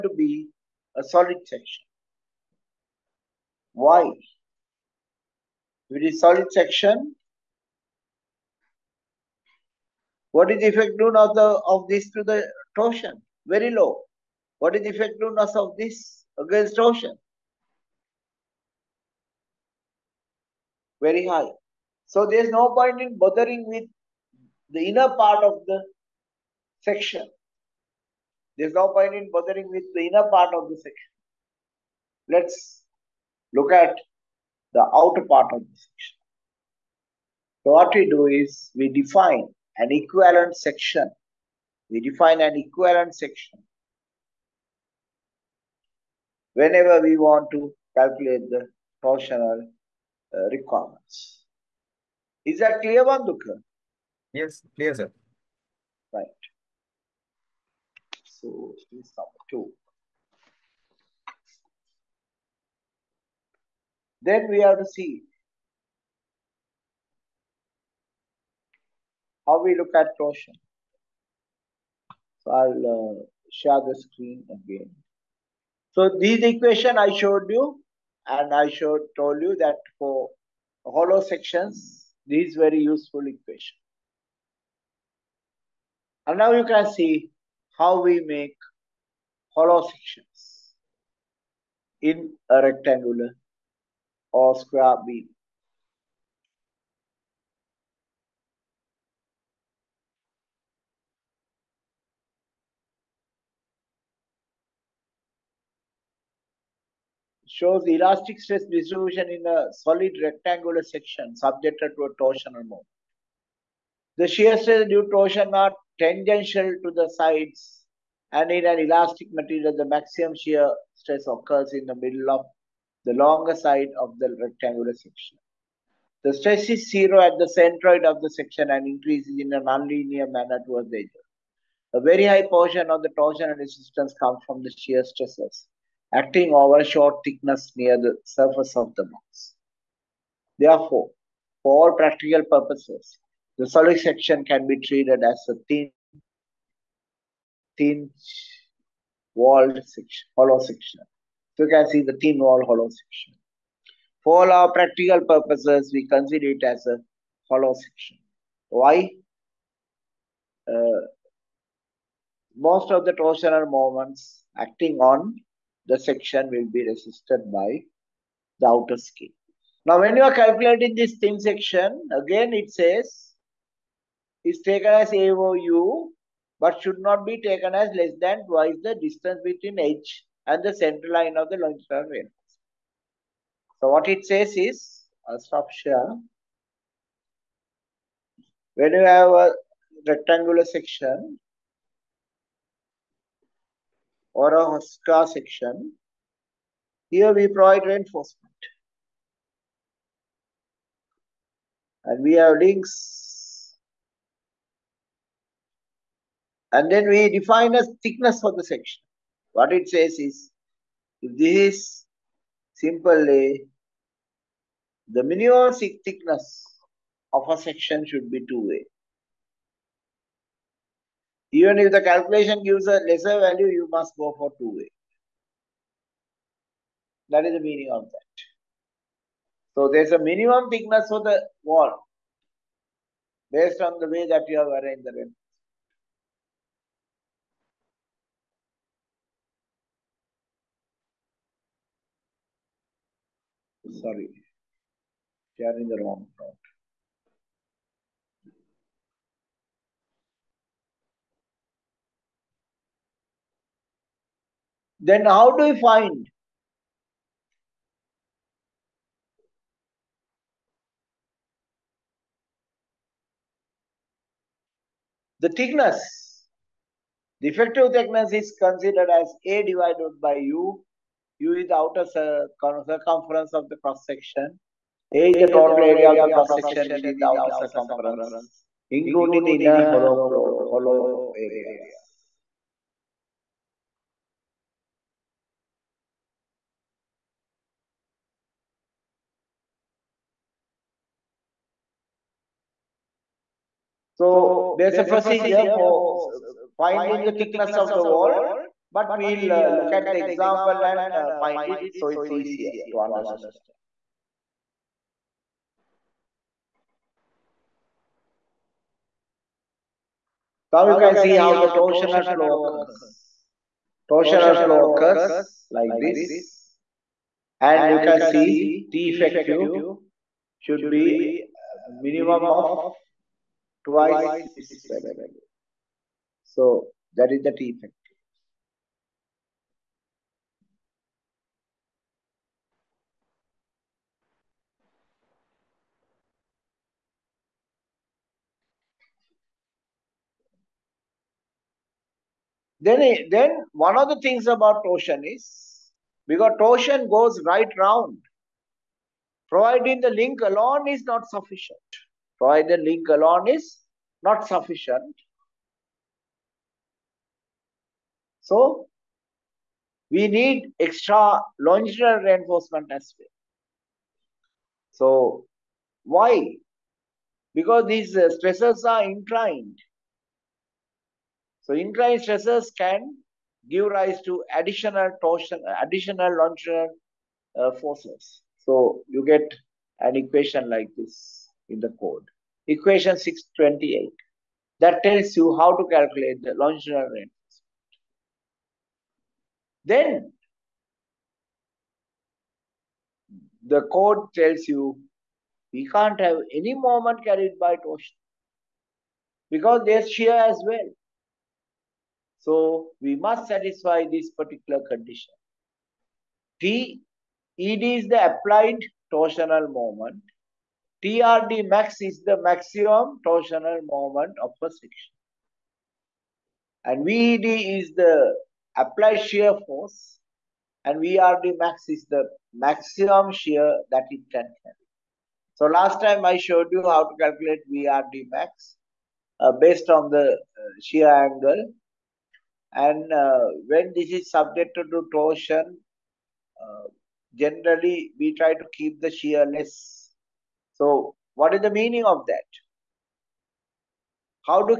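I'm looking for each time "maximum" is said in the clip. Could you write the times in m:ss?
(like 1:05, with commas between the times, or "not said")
1:59, 6:52, 7:02.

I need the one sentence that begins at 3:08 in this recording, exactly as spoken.
When you have a rectangular section, or a HOSTA section.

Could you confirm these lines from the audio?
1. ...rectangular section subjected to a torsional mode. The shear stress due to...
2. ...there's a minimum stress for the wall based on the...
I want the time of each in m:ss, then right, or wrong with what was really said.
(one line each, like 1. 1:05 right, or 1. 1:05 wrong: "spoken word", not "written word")
1. 1:50 right
2. 3:49 wrong: "thickness", not "stress".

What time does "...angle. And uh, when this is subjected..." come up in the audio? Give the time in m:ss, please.
7:11.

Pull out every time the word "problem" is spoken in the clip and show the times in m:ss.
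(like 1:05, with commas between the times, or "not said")
4:06.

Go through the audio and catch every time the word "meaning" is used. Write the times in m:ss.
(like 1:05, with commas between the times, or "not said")
3:47, 7:21.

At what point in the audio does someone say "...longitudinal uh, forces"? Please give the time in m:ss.
6:16.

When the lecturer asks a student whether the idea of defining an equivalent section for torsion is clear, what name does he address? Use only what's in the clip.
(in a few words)
Vanduka.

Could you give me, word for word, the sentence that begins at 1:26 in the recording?
And now you can see how we make hollow sections in a rectangular or square beam.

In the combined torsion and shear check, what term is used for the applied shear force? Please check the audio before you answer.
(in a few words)
VED.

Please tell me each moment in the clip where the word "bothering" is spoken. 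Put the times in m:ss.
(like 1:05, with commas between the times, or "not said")
0:23, 0:29.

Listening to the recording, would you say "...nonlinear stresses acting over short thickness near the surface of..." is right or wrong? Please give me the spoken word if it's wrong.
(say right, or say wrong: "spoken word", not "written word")
wrong: "shear", not "nonlinear".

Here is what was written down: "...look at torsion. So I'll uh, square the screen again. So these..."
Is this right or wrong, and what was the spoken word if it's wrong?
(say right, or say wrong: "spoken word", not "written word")
wrong: "share", not "square".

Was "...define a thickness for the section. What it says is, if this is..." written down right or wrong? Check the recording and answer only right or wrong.
right.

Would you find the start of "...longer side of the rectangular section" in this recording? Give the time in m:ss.
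2:03.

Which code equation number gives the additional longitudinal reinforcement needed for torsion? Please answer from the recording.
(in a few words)
6.28.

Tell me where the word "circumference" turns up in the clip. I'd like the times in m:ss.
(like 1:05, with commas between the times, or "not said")
4:32, 4:37.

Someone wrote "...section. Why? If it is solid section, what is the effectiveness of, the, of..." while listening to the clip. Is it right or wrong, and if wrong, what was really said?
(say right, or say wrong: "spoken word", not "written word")
right.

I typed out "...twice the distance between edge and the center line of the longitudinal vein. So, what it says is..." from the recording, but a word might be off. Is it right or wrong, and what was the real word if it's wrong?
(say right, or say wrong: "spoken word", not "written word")
right.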